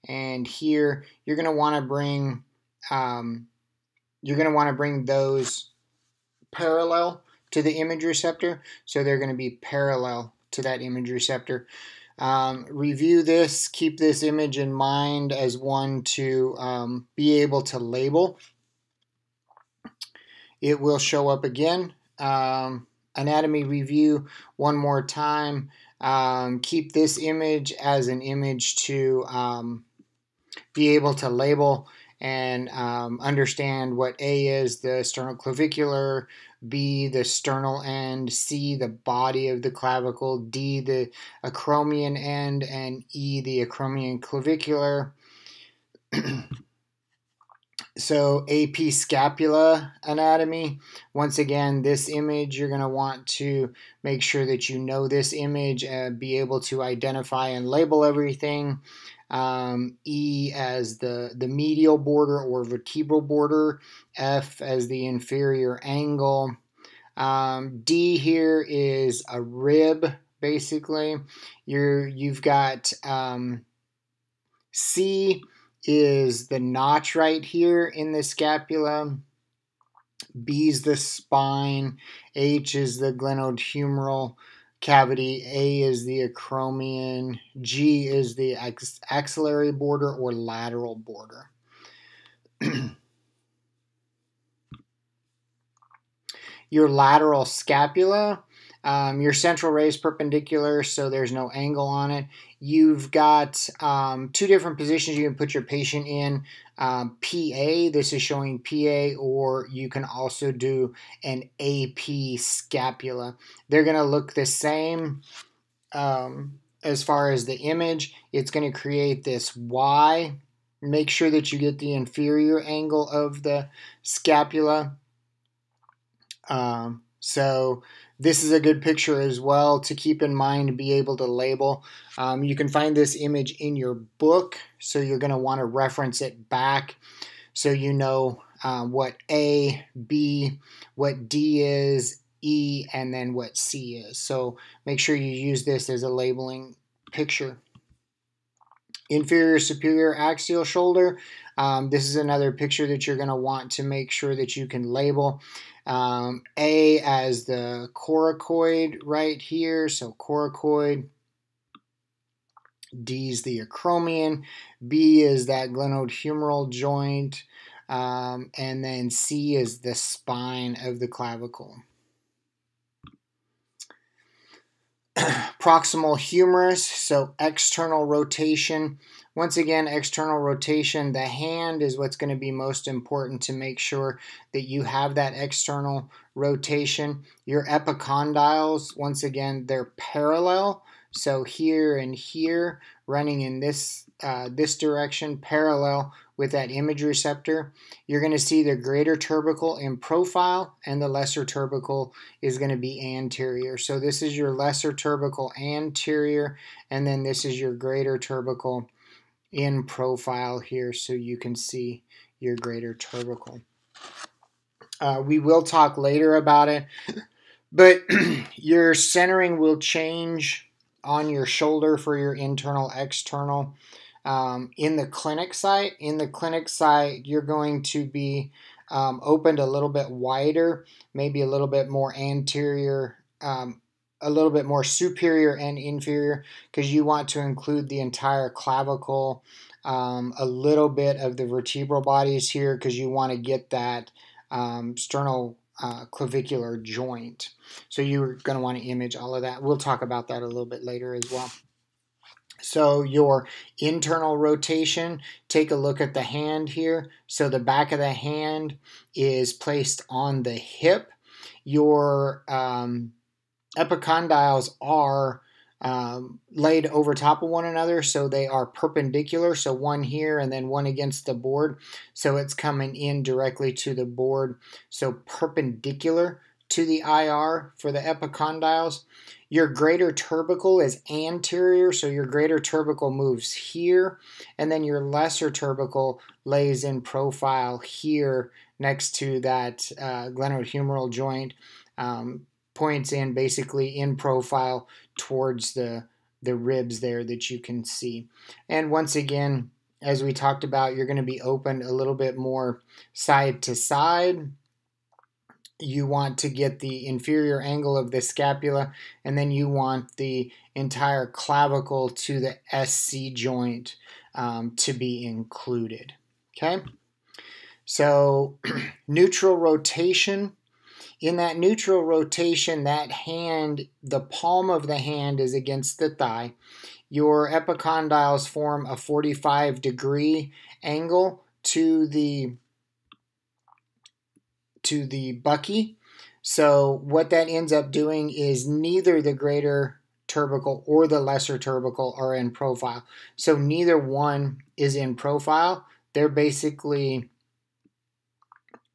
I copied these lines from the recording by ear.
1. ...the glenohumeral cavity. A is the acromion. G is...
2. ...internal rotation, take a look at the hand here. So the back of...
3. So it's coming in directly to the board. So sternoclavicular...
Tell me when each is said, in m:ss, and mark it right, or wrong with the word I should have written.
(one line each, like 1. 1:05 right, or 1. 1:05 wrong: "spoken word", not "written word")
1. 1:22 right
2. 4:13 right
3. 4:32 wrong: "perpendicular", not "sternoclavicular".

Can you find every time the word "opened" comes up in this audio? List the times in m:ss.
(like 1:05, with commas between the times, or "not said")
3:49, 5:01.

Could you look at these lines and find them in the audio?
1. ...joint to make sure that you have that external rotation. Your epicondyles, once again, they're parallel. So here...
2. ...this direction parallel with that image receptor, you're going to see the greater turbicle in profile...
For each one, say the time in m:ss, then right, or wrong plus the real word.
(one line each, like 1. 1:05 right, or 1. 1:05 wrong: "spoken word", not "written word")
1. 3:02 wrong: "important", not "joint"
2. 3:14 wrong: "tubercle", not "turbicle".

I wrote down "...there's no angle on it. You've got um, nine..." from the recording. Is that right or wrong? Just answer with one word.
wrong.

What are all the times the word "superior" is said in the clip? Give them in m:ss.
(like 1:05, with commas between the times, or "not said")
2:29, 3:54.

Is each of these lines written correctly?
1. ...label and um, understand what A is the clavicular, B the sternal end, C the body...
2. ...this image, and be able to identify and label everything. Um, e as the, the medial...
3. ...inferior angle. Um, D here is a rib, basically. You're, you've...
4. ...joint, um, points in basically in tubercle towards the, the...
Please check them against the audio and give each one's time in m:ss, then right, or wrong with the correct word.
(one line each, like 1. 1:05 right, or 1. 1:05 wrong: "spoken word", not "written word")
1. 0:31 wrong: "sternoclavicular", not "clavicular"
2. 0:55 right
3. 1:05 right
4. 4:51 wrong: "profile", not "tubercle".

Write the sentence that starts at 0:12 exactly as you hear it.
Um, review this, keep this image in mind as one to um, be able to label it will show up again.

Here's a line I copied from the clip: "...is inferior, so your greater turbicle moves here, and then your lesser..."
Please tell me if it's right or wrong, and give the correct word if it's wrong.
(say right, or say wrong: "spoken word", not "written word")
wrong: "anterior", not "inferior".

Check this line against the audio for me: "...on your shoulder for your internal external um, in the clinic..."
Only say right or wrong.
right.